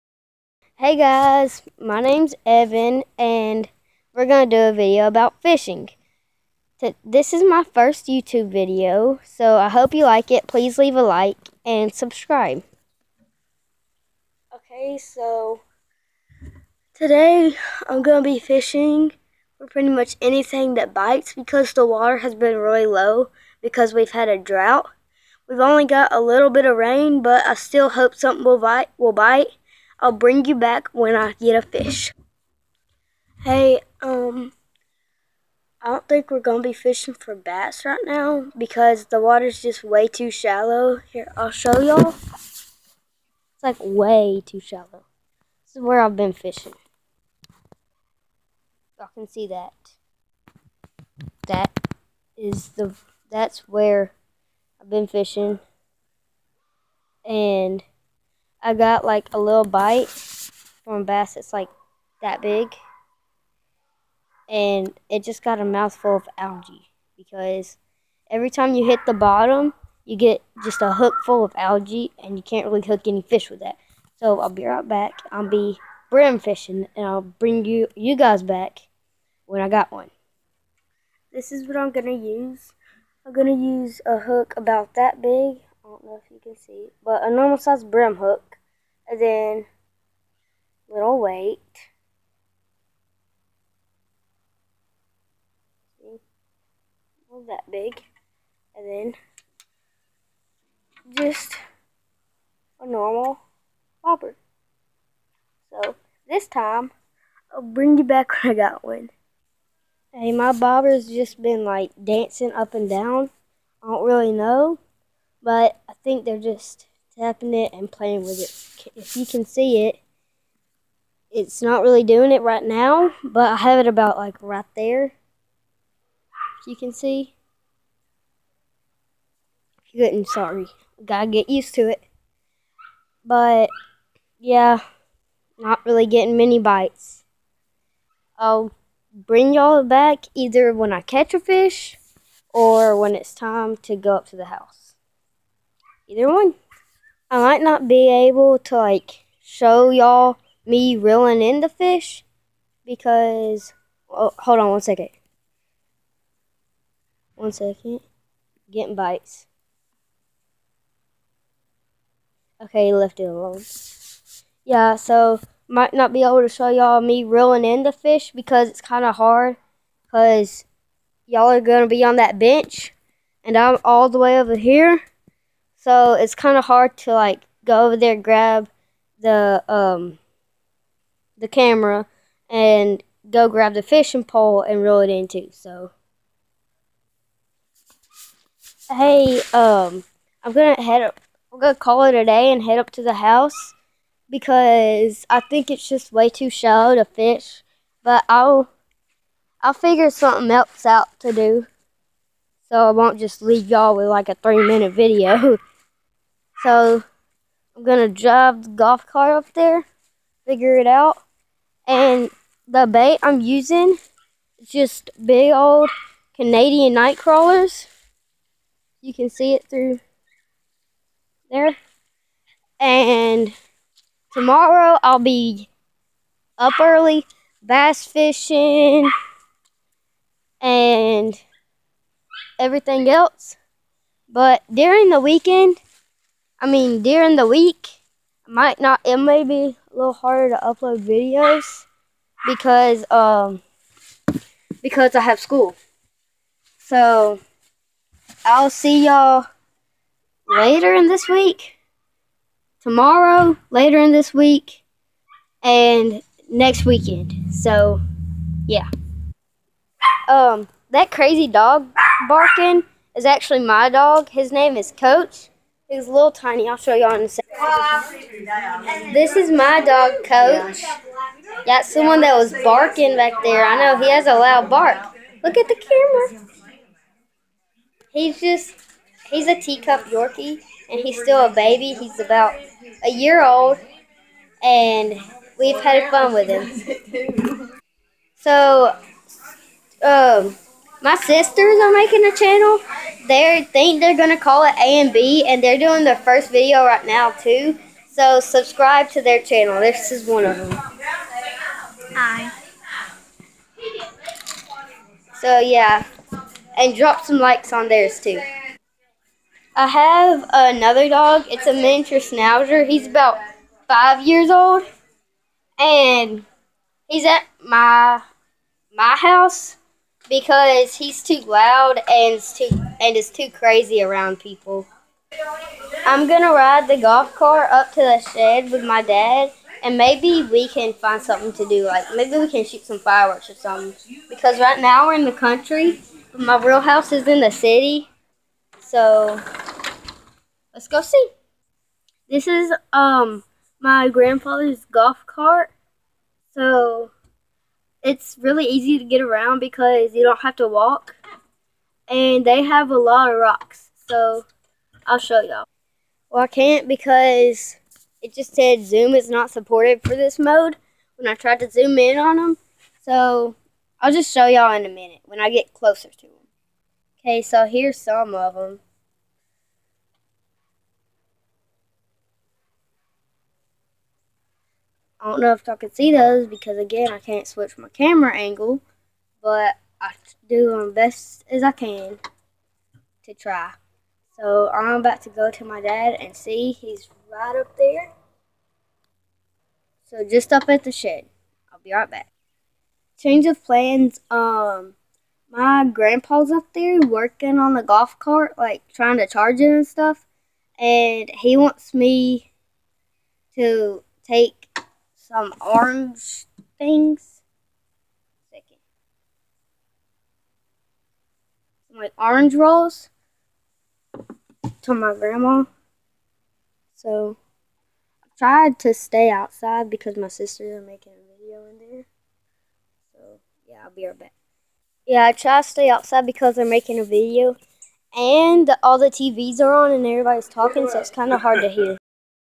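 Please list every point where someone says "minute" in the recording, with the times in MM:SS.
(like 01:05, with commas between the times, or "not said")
03:24, 06:04.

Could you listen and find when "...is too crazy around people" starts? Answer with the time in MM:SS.
05:23.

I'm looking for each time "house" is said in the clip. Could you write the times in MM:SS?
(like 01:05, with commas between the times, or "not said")
02:24, 03:13, 05:19, 05:36.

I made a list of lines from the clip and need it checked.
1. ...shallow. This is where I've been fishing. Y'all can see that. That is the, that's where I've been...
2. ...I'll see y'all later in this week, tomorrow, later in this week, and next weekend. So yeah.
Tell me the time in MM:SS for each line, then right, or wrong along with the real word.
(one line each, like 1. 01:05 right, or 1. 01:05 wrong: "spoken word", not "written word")
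1. 00:44 right
2. 04:08 right.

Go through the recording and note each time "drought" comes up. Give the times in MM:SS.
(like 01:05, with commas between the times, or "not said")
00:24.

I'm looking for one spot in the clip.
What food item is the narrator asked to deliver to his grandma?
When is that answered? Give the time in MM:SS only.
06:52.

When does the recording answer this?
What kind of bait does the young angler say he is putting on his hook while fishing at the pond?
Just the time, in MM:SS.
03:36.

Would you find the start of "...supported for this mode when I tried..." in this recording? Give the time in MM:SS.
05:59.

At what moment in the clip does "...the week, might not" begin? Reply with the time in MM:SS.
03:57.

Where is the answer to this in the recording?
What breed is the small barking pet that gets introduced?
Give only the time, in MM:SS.
04:39.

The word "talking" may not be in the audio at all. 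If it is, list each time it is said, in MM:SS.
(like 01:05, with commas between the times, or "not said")
07:10.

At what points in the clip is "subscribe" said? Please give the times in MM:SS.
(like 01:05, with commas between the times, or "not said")
00:11, 04:58.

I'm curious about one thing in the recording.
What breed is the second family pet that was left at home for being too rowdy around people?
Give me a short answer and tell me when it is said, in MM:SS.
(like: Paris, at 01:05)
miniature schnauzer, at 05:11.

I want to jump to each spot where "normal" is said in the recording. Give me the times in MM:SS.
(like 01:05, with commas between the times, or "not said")
01:27, 01:42.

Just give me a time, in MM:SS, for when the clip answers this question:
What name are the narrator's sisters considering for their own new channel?
04:54.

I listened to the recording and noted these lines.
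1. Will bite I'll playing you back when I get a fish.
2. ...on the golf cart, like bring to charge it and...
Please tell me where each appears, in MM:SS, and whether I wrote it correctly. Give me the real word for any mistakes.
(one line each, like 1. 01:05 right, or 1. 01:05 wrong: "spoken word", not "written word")
1. 00:28 wrong: "bring", not "playing"
2. 06:37 wrong: "trying", not "bring".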